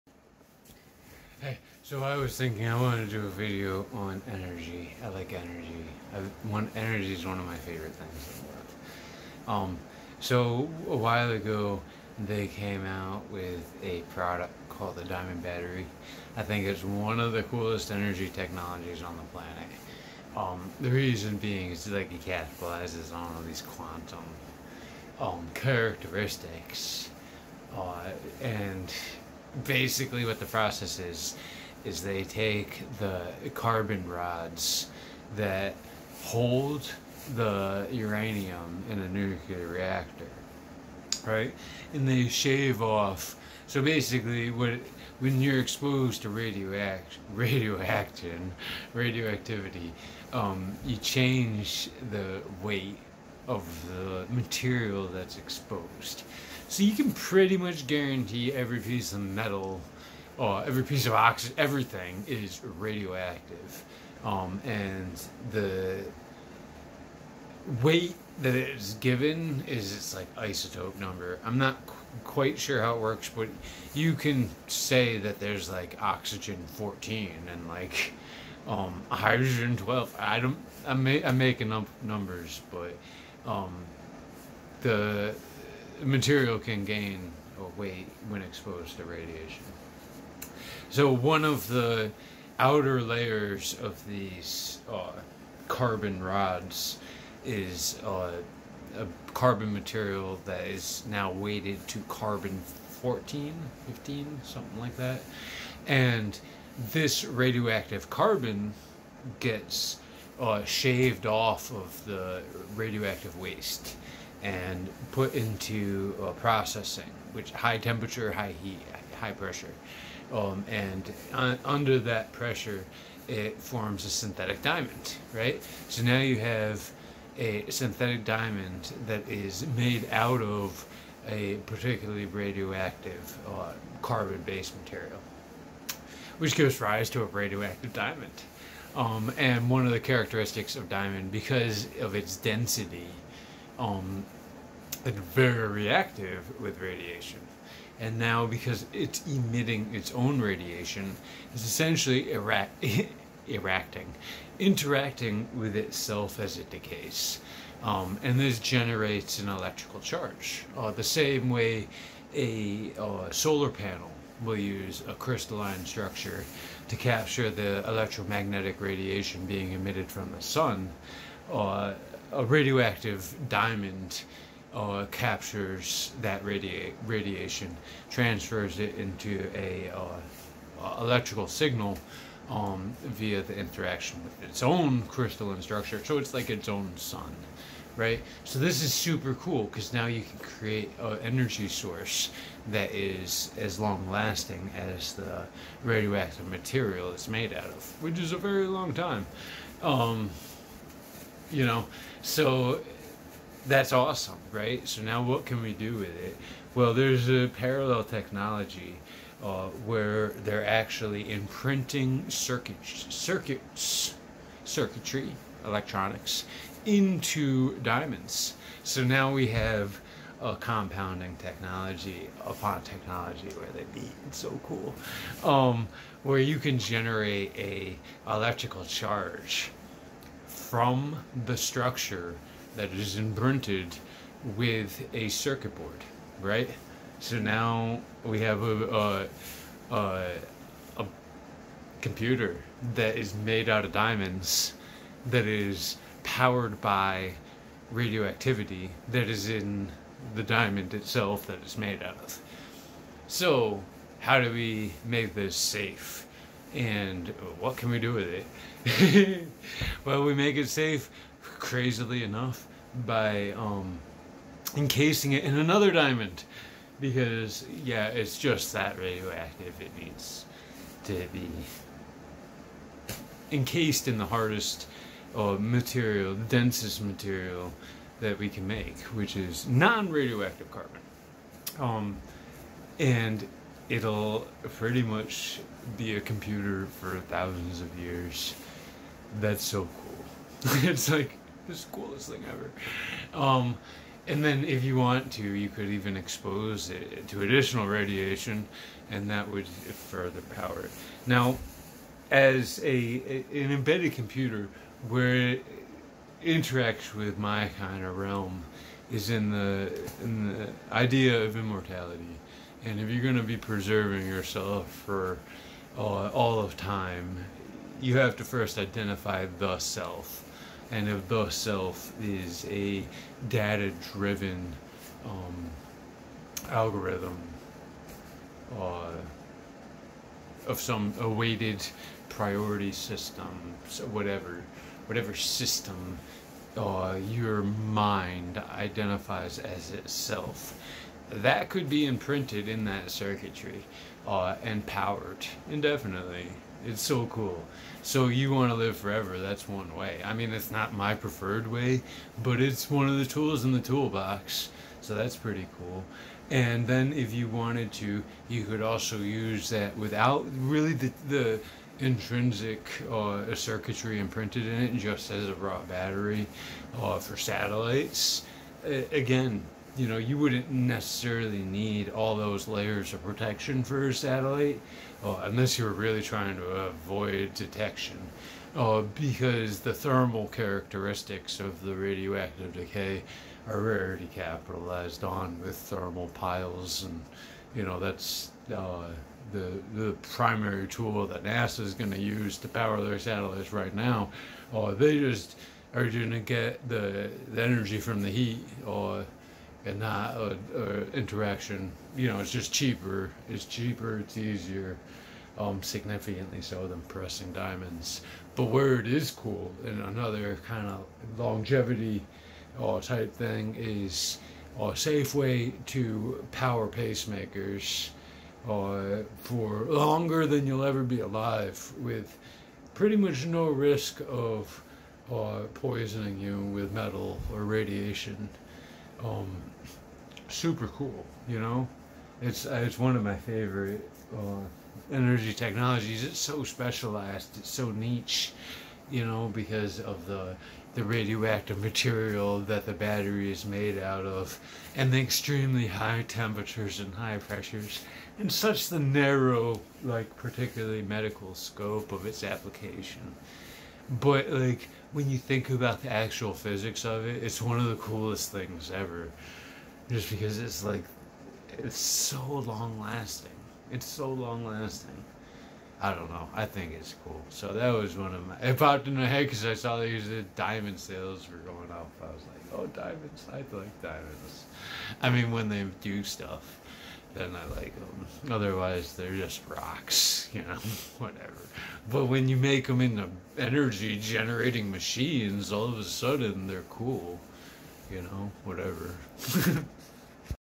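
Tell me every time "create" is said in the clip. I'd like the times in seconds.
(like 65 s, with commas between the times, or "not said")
190 s.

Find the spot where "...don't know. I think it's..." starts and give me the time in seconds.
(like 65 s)
466 s.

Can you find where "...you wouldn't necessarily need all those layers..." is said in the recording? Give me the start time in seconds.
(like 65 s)
370 s.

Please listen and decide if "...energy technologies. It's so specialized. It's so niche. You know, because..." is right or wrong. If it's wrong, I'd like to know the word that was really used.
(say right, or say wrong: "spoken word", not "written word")
right.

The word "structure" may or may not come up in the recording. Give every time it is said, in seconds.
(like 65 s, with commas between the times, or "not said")
165 s, 185 s, 231 s.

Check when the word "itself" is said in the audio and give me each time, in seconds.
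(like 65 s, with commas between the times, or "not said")
155 s, 250 s, 339 s.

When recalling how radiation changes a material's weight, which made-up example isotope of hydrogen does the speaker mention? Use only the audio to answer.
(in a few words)
hydrogen 12.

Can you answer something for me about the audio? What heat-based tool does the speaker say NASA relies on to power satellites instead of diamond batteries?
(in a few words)
thermal piles.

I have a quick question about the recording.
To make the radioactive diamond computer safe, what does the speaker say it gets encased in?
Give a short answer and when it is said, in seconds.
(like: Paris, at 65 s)
another diamond, at 265 s.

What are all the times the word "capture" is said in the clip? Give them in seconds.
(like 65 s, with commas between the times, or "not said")
166 s, 175 s.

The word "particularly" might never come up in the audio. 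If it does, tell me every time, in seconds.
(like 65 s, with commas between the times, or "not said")
131 s, 450 s.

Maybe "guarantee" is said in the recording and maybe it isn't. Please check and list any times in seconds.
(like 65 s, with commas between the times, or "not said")
57 s.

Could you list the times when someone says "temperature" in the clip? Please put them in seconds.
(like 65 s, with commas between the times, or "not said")
117 s, 446 s.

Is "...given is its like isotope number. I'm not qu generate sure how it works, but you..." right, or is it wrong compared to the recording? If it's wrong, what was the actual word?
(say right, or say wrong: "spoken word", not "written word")
wrong: "quite", not "generate".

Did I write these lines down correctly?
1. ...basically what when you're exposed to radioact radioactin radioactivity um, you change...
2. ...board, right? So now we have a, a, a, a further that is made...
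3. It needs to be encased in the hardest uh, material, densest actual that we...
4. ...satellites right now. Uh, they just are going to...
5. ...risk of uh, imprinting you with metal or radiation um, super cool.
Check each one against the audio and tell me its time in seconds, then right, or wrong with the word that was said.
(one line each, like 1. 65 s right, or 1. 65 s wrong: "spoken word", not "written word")
1. 43 s right
2. 235 s wrong: "computer", not "further"
3. 269 s wrong: "material", not "actual"
4. 393 s right
5. 423 s wrong: "poisoning", not "imprinting".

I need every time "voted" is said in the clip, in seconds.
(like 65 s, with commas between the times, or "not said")
not said.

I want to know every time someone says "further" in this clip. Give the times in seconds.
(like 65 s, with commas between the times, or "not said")
299 s.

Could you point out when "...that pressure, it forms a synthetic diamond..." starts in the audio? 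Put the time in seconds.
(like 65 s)
121 s.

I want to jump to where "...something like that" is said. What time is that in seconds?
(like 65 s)
104 s.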